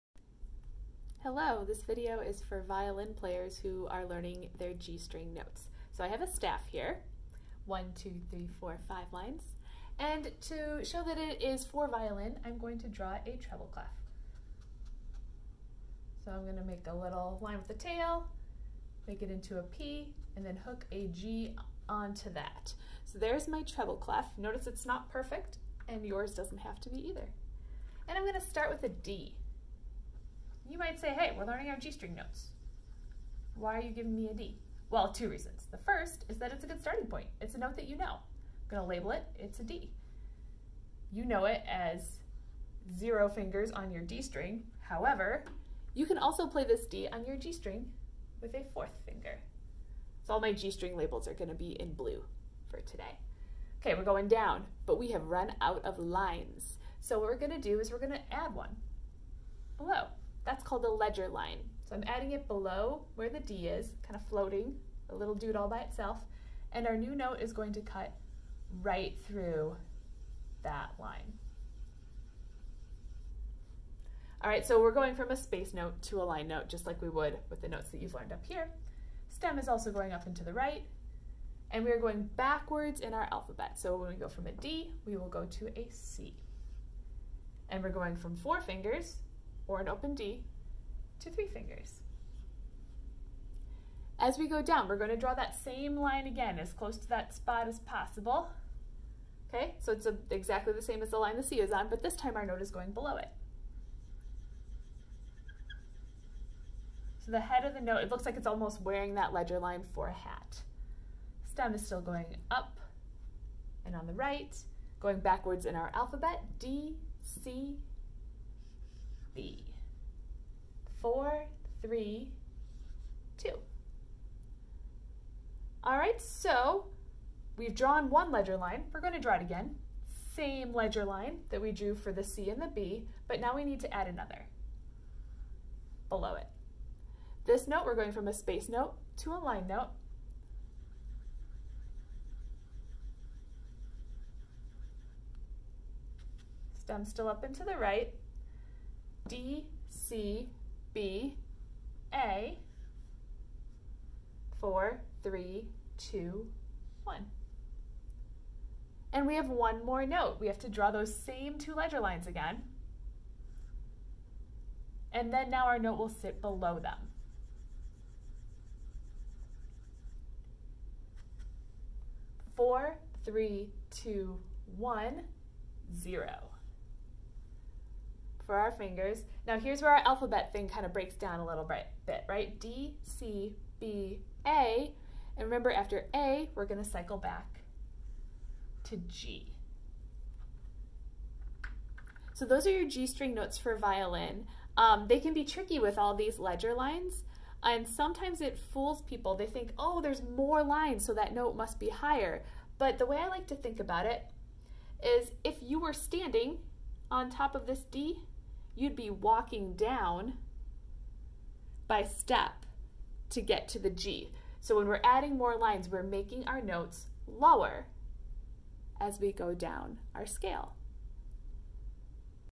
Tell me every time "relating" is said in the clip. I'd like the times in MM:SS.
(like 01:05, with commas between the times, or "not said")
not said.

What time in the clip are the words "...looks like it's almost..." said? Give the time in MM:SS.
01:48.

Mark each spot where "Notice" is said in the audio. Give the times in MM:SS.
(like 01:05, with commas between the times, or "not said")
00:24.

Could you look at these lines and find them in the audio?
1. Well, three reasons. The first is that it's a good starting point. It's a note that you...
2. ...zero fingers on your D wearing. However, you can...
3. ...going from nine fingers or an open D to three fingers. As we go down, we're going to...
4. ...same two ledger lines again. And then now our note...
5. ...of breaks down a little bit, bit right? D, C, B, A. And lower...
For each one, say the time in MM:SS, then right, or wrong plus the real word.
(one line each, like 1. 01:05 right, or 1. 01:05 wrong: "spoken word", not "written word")
1. 00:34 wrong: "two", not "three"
2. 00:42 wrong: "string", not "wearing"
3. 01:27 wrong: "four", not "nine"
4. 02:41 right
5. 03:00 wrong: "remember", not "lower".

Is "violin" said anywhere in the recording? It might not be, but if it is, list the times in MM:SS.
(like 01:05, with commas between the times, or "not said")
00:02, 00:11, 03:13.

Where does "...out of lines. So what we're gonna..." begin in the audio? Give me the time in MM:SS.
00:55.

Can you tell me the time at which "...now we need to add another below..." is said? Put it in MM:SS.
02:13.